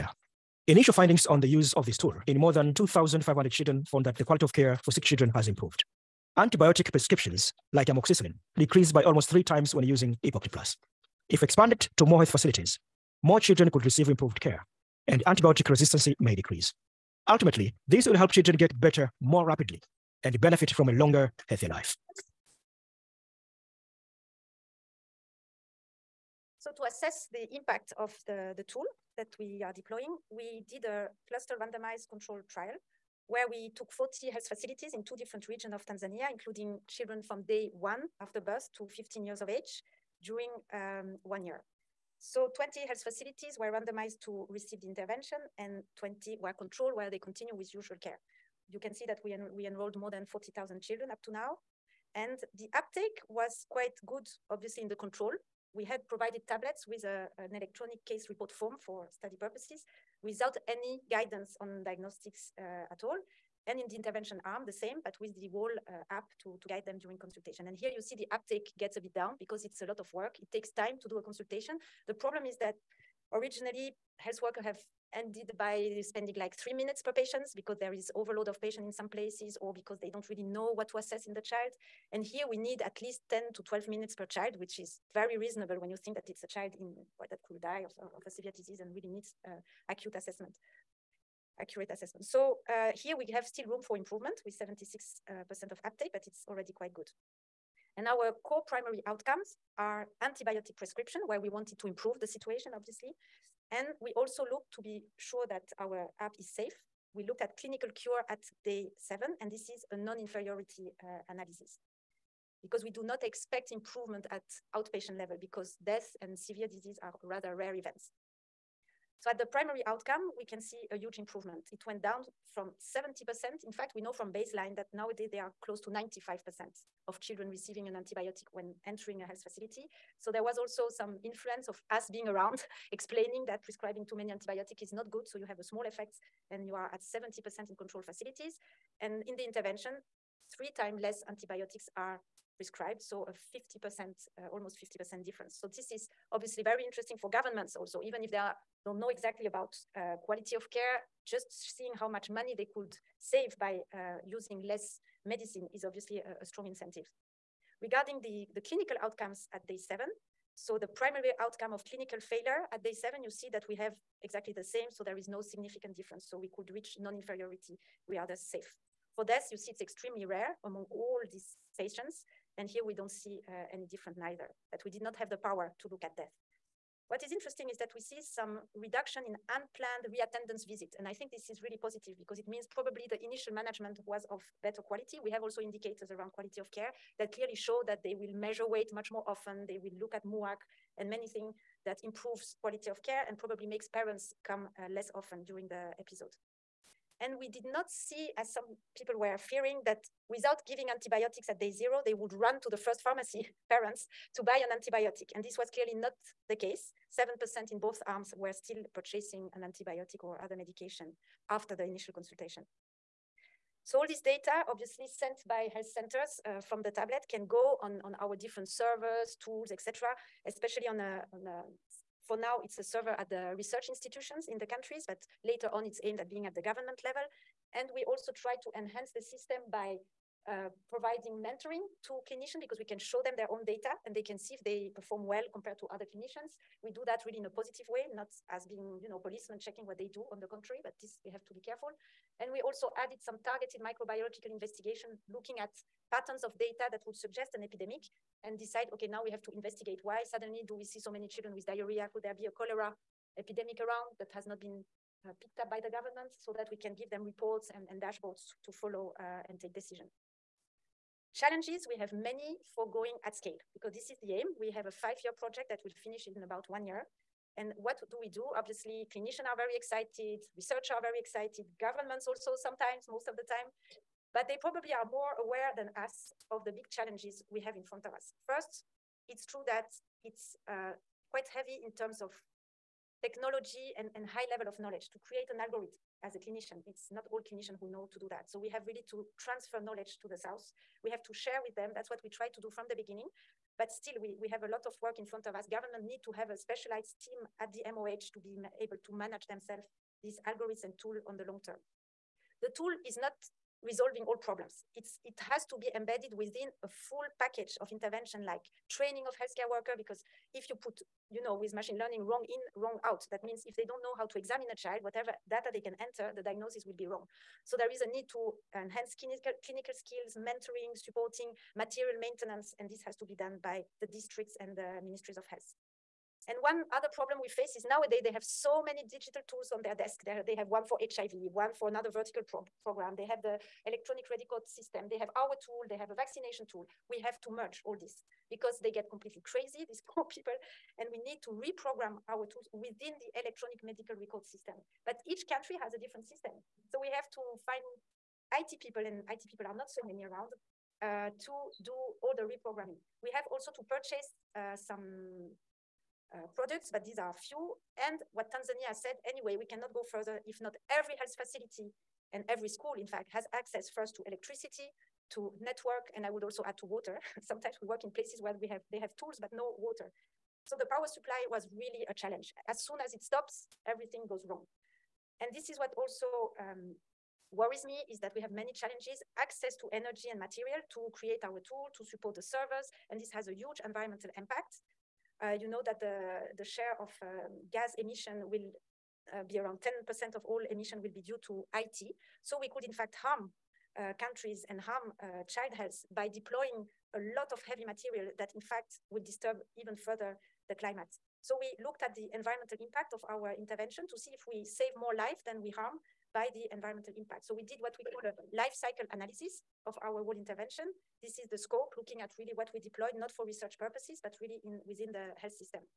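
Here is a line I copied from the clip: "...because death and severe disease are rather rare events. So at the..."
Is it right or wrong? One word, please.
right.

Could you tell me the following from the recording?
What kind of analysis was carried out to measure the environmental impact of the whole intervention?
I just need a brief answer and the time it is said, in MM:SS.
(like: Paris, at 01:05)
life cycle analysis, at 06:48.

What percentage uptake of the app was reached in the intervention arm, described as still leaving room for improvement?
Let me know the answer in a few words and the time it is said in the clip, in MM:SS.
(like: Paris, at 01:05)
76%, at 01:34.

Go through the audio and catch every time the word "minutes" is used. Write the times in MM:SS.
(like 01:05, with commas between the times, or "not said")
01:16, 01:23.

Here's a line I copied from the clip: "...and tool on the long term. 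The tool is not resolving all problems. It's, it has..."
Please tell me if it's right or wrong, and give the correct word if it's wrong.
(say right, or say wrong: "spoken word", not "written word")
right.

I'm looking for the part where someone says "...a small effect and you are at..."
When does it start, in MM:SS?
02:15.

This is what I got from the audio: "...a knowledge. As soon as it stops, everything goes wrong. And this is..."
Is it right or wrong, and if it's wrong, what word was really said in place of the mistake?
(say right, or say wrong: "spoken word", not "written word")
wrong: "challenge", not "knowledge".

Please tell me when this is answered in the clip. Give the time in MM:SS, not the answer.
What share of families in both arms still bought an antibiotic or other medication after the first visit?
03:27.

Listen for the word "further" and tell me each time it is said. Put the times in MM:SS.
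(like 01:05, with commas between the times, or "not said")
06:00, 06:39.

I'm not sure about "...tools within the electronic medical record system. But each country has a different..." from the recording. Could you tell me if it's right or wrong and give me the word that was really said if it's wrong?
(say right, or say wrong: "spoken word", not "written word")
right.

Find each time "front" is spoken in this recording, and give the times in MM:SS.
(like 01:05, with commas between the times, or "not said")
04:37, 04:55.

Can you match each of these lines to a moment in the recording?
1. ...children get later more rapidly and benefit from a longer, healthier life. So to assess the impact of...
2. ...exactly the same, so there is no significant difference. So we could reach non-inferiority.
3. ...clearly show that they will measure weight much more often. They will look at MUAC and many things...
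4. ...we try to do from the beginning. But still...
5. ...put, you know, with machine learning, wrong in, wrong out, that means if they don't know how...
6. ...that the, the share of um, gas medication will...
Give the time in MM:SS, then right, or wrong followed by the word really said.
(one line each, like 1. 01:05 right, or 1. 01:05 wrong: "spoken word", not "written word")
1. 00:18 wrong: "better", not "later"
2. 02:44 right
3. 03:07 right
4. 04:52 right
5. 05:10 right
6. 06:25 wrong: "emission", not "medication".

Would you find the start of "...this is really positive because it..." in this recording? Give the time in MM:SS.
03:01.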